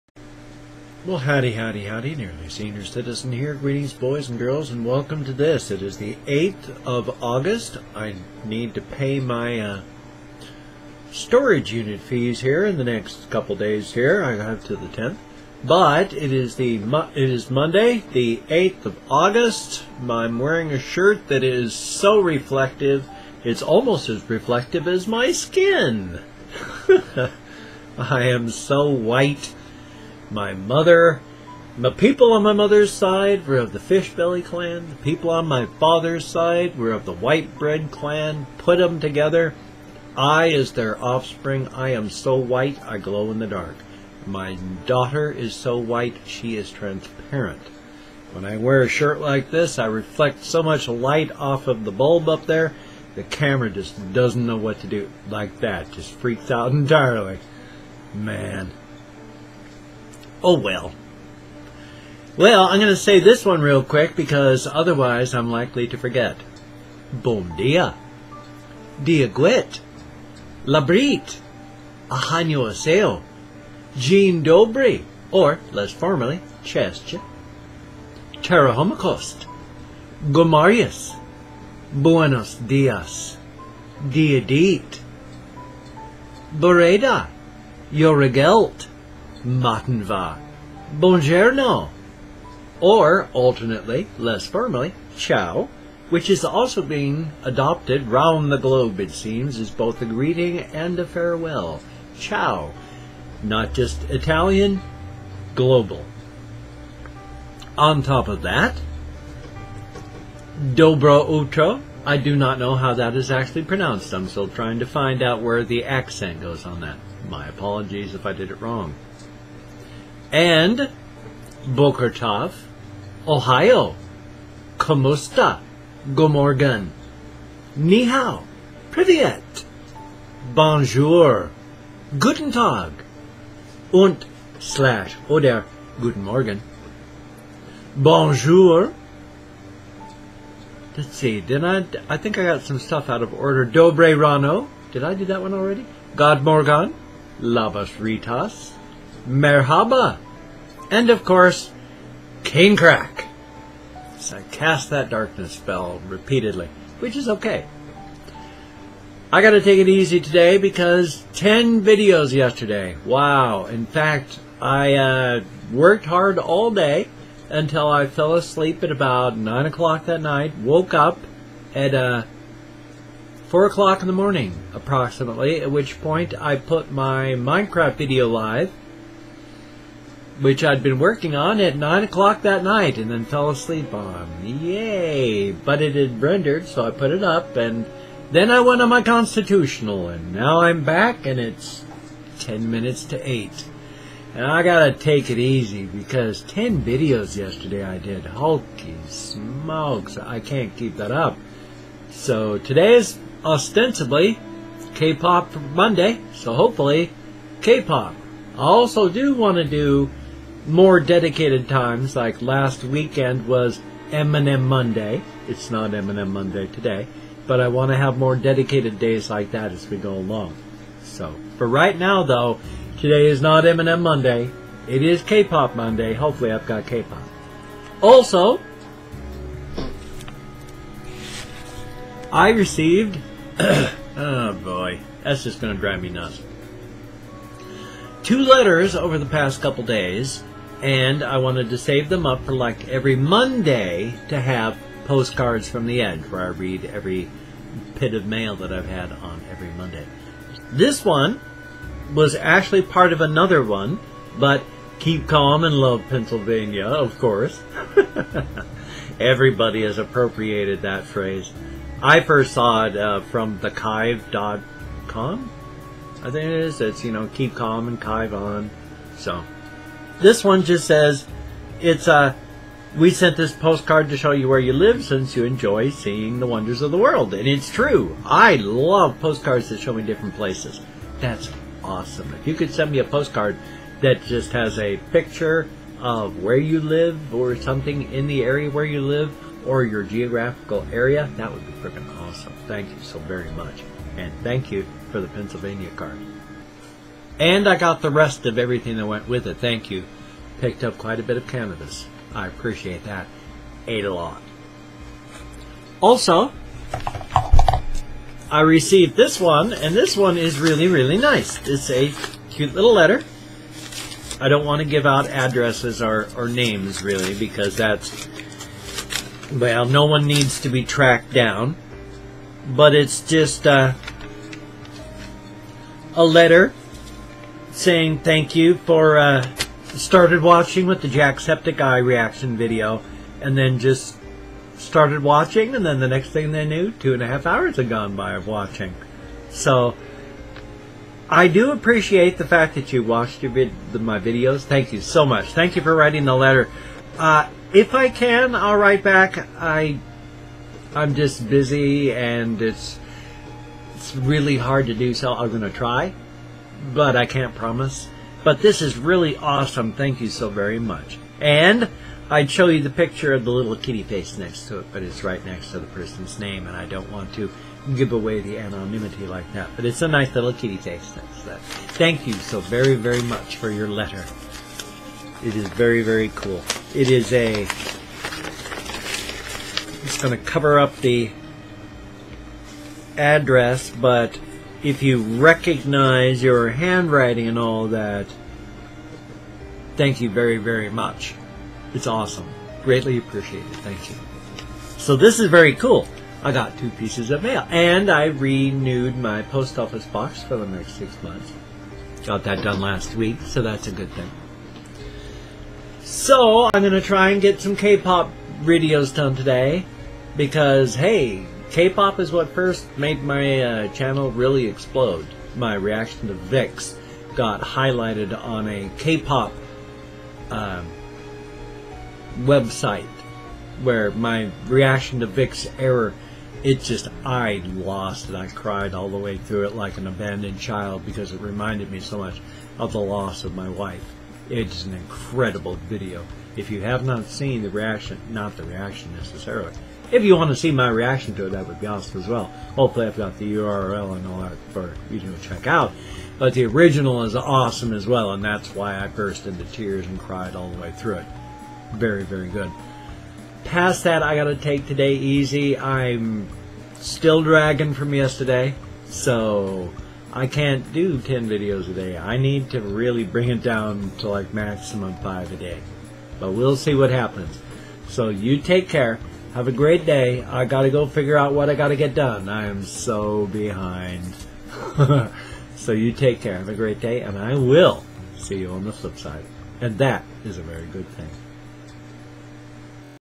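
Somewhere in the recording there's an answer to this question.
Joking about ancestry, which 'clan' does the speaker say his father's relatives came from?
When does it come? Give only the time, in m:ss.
0:37.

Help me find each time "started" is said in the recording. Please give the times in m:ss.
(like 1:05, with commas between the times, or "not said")
5:29, 5:34.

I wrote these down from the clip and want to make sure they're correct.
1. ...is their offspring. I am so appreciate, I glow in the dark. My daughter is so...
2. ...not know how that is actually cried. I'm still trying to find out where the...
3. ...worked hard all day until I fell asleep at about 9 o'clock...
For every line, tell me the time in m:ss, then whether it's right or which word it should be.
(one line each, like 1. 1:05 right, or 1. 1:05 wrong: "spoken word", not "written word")
1. 0:40 wrong: "white", not "appreciate"
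2. 1:52 wrong: "pronounced", not "cried"
3. 2:45 right.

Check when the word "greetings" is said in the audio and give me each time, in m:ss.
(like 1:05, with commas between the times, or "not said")
0:03, 1:40.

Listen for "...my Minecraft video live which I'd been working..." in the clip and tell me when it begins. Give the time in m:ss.
2:56.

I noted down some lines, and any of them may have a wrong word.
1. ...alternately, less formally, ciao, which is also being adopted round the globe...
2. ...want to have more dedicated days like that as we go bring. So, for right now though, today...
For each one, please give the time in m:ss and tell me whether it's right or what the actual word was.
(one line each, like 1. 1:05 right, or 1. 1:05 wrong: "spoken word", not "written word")
1. 1:33 right
2. 3:37 wrong: "along", not "bring".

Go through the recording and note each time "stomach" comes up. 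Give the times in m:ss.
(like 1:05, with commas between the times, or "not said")
not said.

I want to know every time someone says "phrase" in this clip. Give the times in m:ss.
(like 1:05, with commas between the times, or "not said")
4:21.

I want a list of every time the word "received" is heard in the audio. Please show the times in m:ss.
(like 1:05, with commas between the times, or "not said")
3:52, 5:08.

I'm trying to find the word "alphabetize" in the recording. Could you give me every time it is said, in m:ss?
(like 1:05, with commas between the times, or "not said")
not said.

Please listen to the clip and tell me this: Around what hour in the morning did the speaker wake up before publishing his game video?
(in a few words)
4 o'clock.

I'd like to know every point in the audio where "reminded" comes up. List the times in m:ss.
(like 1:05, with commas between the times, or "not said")
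7:11.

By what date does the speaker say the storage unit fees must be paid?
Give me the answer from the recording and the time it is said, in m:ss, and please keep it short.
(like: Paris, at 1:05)
the 10th, at 0:14.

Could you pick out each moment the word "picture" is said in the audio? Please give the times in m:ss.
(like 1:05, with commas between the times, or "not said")
4:45, 6:02.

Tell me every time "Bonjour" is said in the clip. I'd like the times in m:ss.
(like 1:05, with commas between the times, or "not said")
2:10, 2:17.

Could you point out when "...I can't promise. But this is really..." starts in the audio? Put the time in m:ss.
5:57.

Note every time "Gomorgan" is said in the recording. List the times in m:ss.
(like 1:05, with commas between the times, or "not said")
2:06.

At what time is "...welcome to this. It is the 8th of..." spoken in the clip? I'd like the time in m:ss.
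0:04.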